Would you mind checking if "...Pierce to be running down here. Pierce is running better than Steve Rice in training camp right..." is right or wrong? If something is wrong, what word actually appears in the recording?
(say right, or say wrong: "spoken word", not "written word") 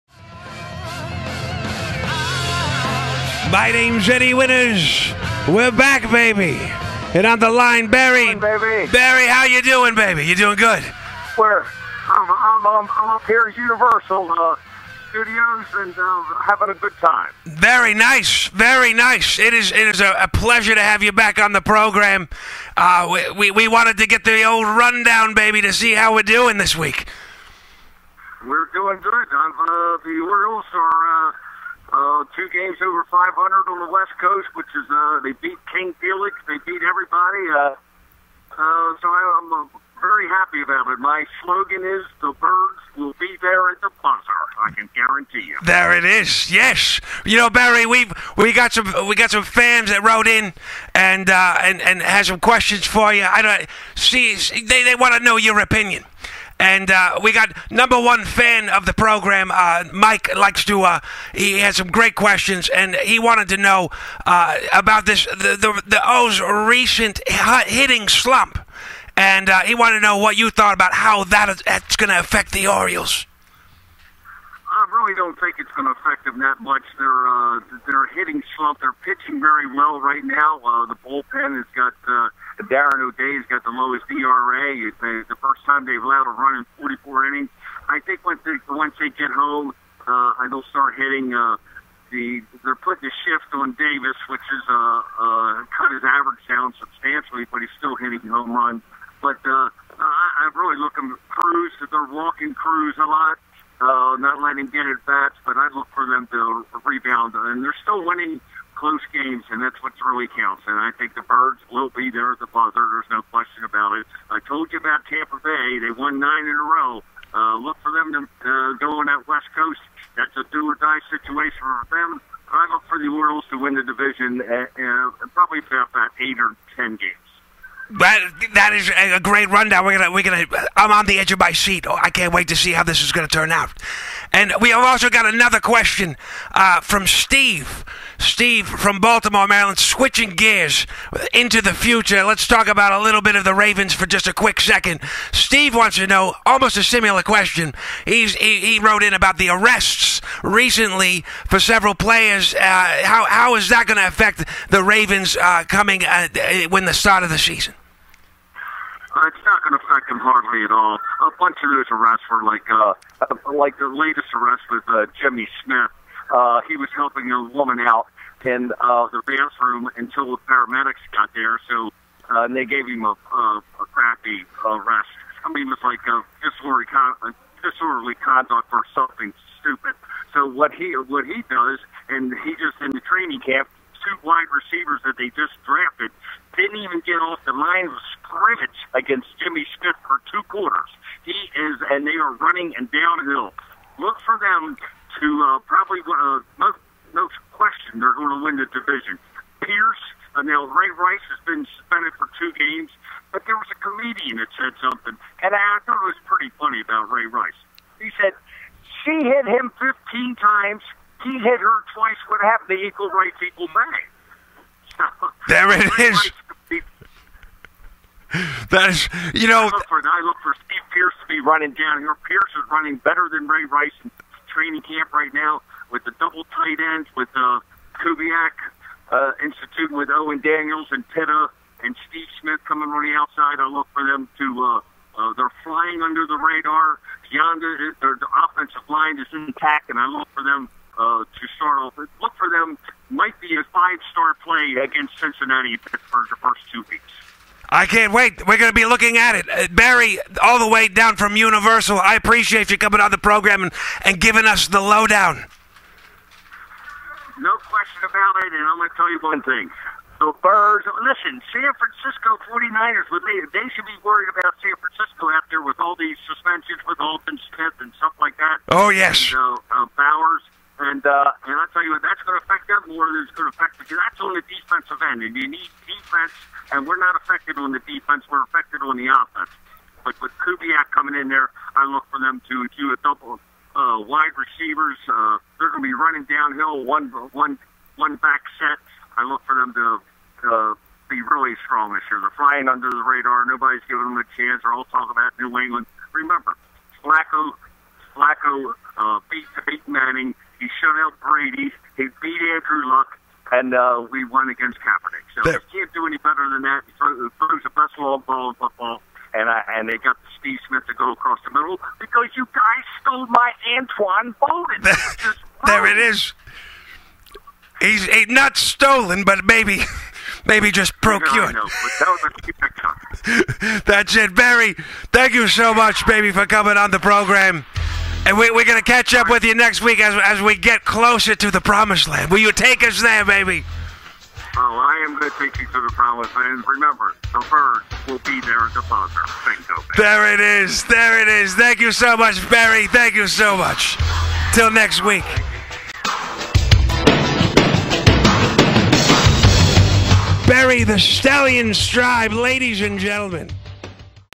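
wrong: "Ray", not "Steve".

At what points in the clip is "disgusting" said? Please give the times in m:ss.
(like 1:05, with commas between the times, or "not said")
not said.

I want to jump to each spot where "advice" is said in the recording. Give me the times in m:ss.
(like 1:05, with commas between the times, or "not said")
not said.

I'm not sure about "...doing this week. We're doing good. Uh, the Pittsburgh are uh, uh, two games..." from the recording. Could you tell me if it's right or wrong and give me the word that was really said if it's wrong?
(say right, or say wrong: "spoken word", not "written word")
wrong: "Orioles", not "Pittsburgh".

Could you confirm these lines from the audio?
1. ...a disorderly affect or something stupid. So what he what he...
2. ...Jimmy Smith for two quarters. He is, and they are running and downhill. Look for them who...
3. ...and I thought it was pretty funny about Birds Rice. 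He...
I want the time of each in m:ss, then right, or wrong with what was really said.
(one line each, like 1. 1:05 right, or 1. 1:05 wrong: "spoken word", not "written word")
1. 2:57 wrong: "conduct", not "affect"
2. 3:09 right
3. 3:25 wrong: "Ray", not "Birds".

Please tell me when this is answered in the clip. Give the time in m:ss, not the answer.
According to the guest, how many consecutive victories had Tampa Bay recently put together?
1:56.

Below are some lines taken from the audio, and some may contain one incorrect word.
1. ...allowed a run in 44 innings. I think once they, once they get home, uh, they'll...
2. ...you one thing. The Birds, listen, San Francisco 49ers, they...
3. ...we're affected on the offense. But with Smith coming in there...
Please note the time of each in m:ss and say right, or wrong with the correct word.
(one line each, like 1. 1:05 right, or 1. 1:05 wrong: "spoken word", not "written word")
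1. 1:26 right
2. 4:19 right
3. 4:38 wrong: "Kubiak", not "Smith".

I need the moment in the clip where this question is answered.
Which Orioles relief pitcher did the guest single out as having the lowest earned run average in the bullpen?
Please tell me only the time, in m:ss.
1:22.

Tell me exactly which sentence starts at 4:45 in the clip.
Uh, they're going to be running downhill, one one one back set.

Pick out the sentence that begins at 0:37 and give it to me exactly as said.
Uh, uh, so I, I'm uh, very happy about it.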